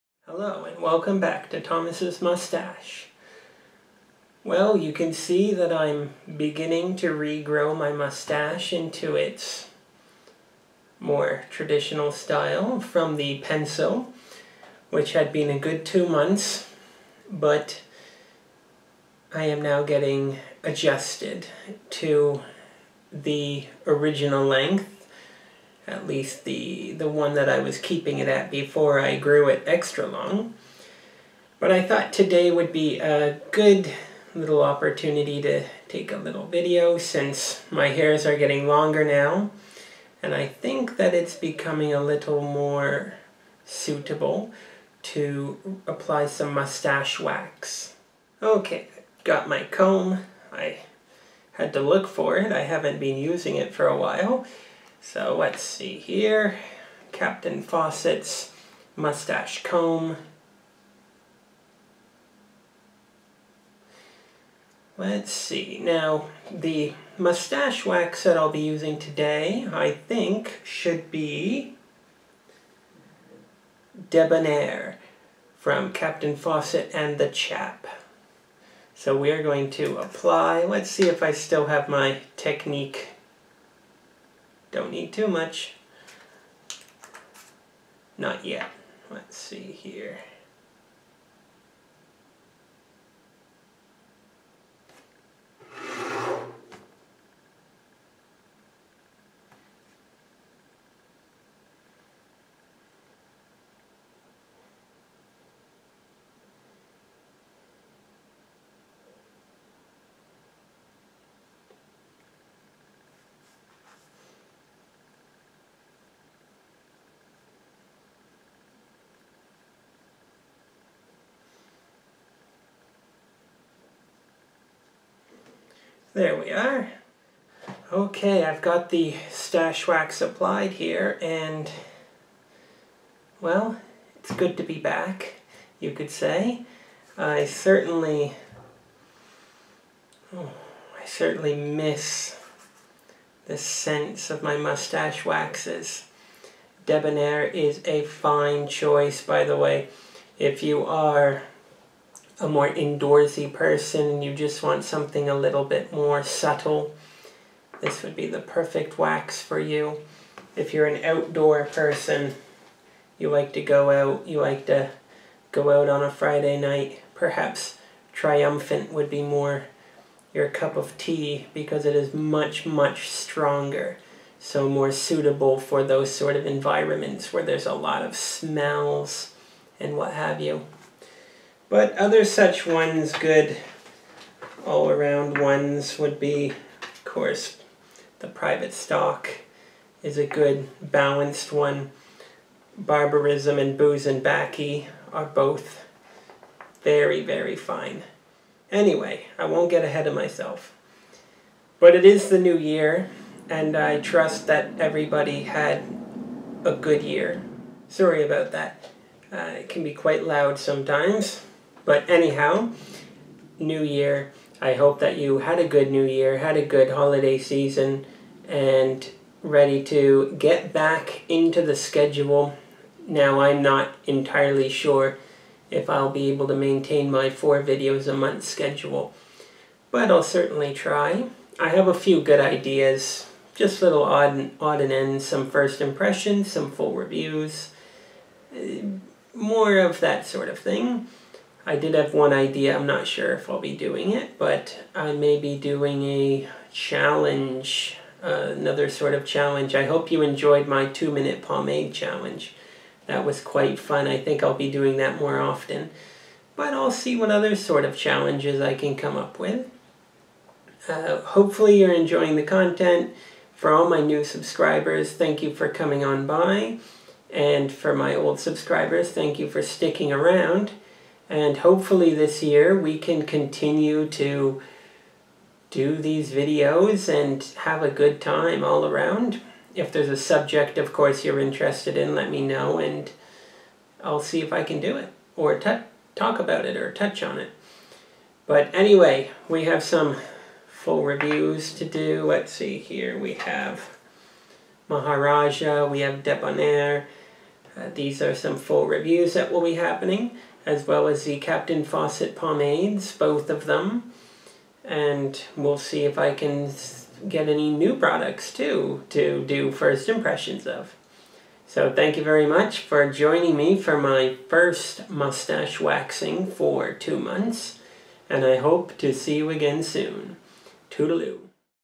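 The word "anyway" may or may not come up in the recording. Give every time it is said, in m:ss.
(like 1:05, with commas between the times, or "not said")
3:18, 4:48.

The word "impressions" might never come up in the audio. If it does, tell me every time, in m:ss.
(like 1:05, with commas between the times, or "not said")
3:55, 5:10.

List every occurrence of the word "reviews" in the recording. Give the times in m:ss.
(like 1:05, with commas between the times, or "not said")
3:56, 4:51, 4:58.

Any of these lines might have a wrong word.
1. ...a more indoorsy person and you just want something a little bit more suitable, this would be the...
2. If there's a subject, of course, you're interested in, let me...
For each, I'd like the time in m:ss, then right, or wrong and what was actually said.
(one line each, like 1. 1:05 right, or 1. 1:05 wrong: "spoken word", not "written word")
1. 2:32 wrong: "subtle", not "suitable"
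2. 4:39 right.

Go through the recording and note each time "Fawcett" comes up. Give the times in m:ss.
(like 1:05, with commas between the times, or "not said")
0:57, 1:16, 5:01.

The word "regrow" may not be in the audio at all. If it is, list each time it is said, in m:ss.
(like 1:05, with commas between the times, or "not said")
0:07.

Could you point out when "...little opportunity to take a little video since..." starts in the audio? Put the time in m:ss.
0:34.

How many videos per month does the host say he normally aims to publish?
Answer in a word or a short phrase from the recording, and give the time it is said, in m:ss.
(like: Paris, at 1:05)
4, at 3:47.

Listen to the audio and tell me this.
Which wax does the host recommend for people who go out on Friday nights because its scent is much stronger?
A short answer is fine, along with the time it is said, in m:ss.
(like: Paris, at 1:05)
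Triumphant, at 2:48.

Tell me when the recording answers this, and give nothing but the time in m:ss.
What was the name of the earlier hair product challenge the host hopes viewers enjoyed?
4:10.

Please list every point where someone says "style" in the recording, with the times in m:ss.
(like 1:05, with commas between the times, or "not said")
0:12.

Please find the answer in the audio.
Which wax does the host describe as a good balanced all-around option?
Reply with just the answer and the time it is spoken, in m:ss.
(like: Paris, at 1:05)
Private Stock, at 3:08.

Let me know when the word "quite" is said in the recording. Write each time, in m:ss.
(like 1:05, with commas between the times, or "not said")
3:29, 4:13.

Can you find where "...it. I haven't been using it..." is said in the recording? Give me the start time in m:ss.
0:52.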